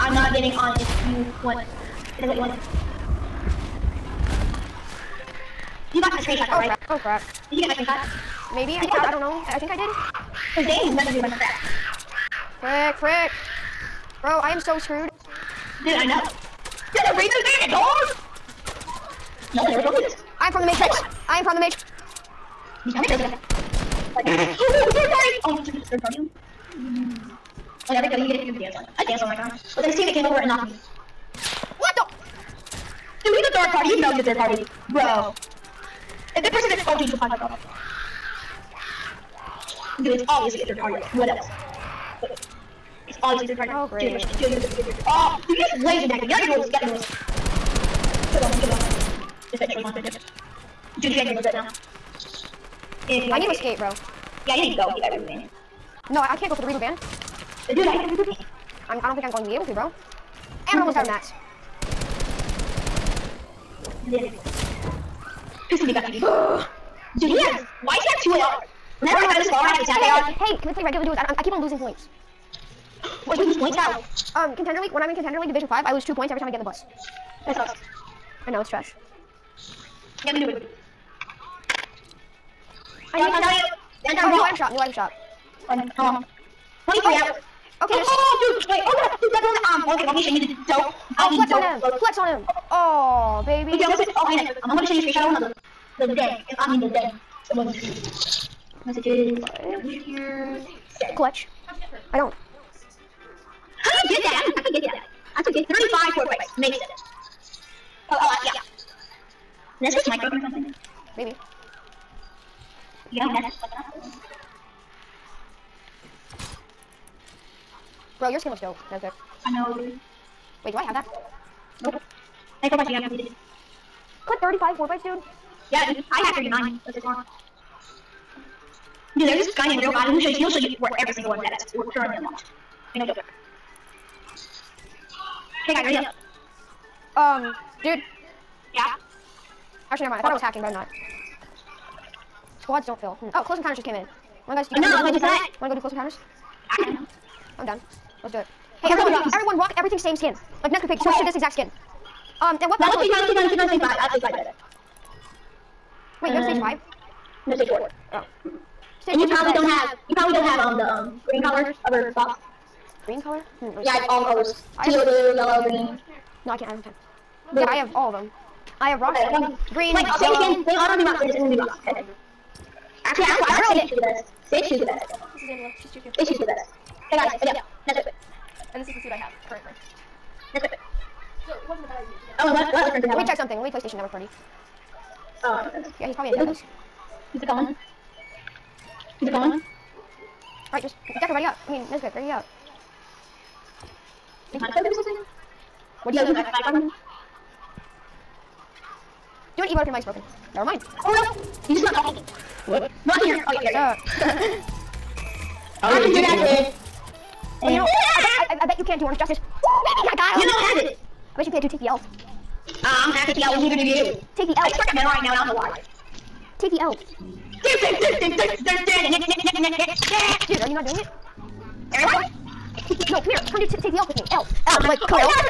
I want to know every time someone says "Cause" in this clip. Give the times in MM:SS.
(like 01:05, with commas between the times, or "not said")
00:10.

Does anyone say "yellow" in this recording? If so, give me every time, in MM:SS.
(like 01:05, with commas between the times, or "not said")
02:45, 02:50.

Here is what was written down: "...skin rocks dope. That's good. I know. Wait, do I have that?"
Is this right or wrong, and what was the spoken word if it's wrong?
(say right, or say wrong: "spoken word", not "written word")
wrong: "looks", not "rocks".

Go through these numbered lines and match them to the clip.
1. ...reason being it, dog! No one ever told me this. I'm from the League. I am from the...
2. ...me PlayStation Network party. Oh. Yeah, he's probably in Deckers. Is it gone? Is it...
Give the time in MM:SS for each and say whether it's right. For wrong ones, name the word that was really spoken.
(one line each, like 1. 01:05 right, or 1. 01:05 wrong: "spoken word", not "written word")
1. 00:17 wrong: "Matrix", not "League"
2. 03:03 right.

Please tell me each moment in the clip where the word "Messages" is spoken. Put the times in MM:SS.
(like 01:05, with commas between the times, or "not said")
01:38.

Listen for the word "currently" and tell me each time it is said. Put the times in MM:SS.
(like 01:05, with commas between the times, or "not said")
02:11, 02:59.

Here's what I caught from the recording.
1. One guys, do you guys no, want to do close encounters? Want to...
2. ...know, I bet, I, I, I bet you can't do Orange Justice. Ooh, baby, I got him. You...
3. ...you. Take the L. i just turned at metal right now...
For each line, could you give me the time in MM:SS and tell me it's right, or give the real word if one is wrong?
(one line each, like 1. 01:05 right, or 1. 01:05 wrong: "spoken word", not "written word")
1. 02:24 right
2. 03:27 right
3. 03:34 right.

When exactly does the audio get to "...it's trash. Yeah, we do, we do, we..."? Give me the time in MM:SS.
01:18.